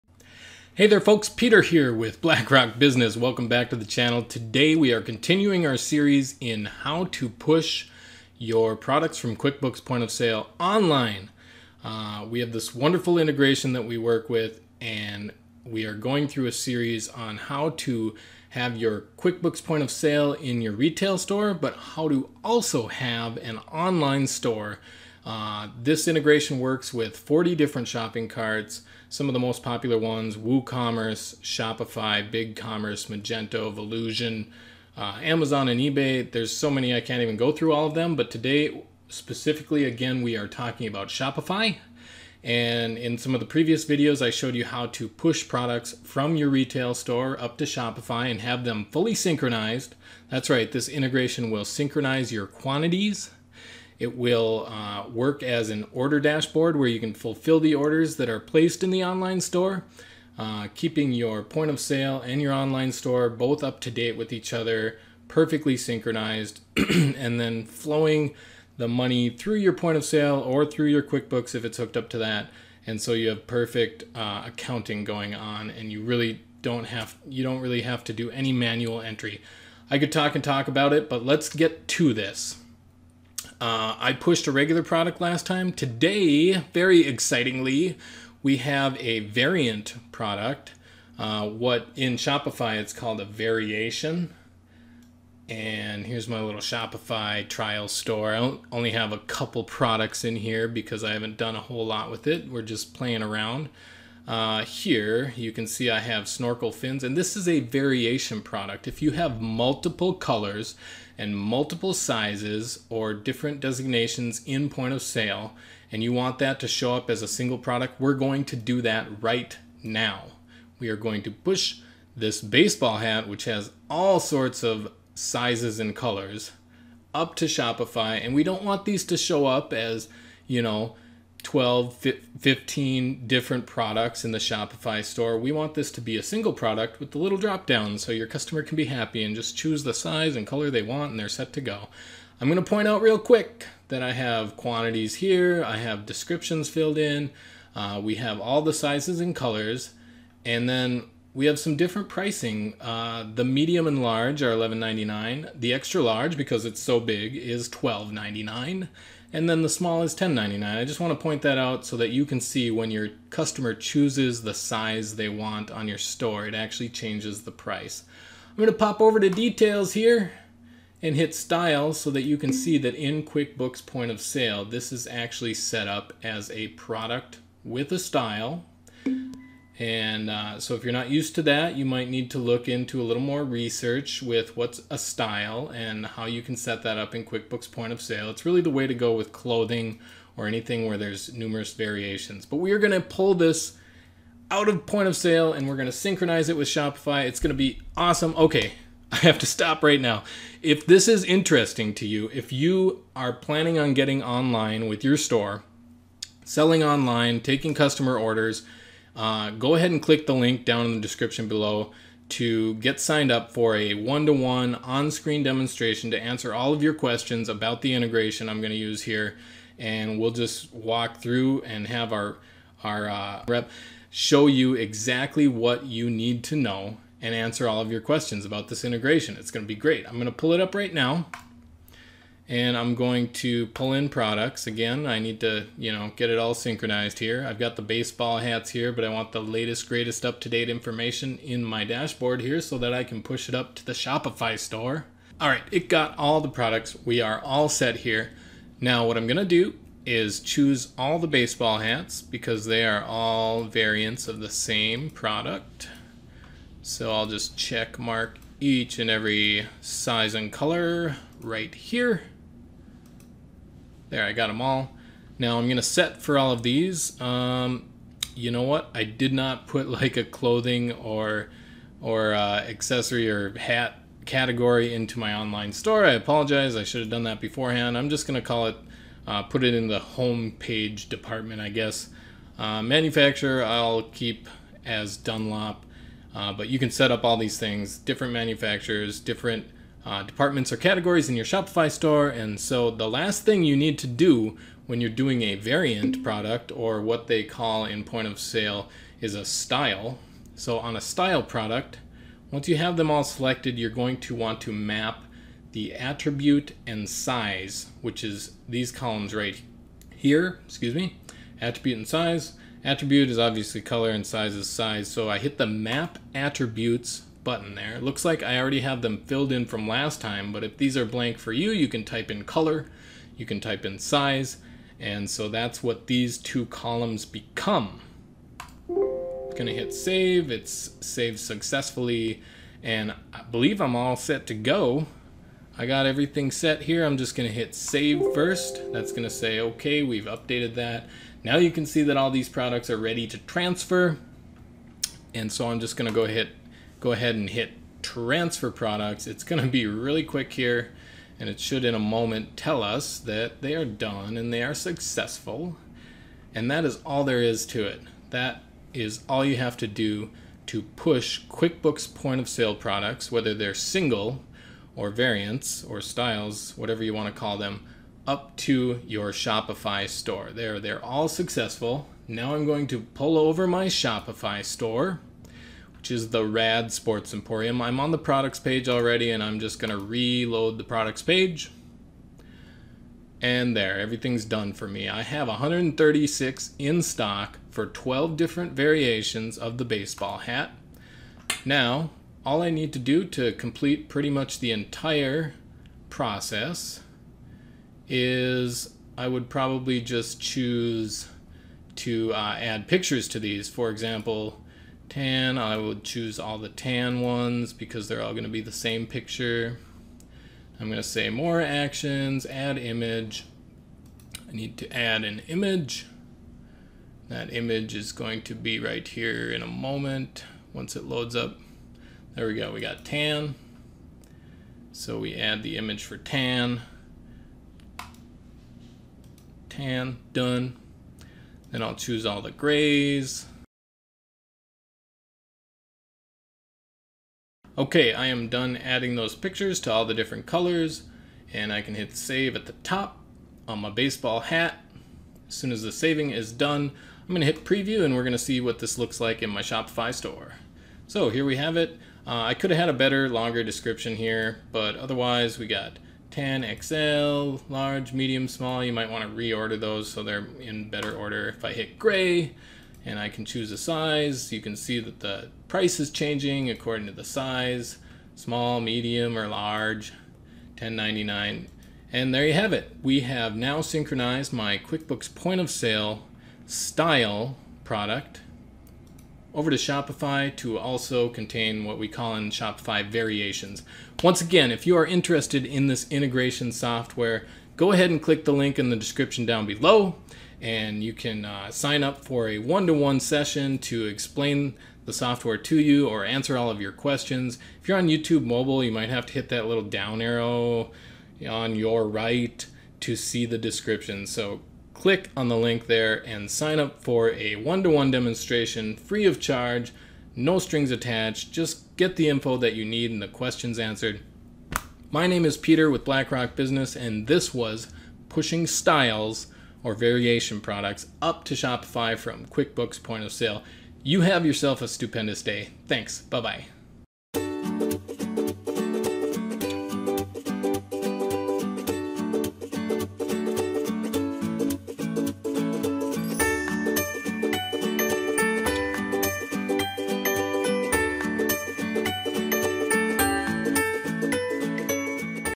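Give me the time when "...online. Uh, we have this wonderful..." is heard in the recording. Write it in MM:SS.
00:10.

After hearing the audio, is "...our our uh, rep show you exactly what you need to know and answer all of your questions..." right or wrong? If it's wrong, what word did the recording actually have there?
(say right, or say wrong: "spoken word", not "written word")
right.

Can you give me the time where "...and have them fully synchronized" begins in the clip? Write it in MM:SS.
00:48.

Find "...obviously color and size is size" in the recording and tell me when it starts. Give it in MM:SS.
05:13.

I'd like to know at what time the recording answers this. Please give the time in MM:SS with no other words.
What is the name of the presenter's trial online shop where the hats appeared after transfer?
06:16.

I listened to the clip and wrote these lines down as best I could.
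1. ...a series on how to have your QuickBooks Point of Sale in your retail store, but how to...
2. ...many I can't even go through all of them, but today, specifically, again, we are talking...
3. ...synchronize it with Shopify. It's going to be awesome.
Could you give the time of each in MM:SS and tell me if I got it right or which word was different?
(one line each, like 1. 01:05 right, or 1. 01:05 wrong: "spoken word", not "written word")
1. 00:16 right
2. 00:36 right
3. 03:15 right.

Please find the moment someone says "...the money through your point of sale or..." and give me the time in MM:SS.
01:08.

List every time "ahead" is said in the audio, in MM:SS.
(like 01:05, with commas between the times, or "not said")
03:29, 05:47, 08:07.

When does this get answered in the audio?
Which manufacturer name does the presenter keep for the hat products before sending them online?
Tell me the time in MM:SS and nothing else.
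04:45.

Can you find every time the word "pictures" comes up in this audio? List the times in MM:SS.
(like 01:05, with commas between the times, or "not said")
06:42, 06:49, 07:19.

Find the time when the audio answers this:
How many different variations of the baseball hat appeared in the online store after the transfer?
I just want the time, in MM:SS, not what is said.
06:27.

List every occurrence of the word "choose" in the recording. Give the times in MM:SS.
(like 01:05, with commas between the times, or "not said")
02:19, 02:43, 04:10, 06:40, 06:46, 07:11, 07:43.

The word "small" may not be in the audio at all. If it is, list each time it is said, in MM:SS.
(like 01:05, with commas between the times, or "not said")
02:39, 07:38, 07:48.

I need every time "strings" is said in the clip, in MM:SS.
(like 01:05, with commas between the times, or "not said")
08:30.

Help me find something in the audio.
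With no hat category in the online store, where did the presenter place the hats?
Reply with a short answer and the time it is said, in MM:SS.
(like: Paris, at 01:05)
home page, at 04:39.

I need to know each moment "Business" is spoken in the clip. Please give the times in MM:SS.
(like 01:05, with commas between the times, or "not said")
00:02, 08:36.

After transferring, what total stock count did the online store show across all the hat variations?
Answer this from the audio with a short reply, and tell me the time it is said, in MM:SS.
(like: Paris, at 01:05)
136, at 06:25.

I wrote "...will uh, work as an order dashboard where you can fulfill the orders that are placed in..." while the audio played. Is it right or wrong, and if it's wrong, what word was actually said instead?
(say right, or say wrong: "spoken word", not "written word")
right.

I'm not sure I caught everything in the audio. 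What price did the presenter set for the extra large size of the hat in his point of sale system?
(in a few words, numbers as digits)
$12.99.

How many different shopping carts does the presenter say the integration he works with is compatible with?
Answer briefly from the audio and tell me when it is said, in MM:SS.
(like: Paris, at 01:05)
40, at 00:27.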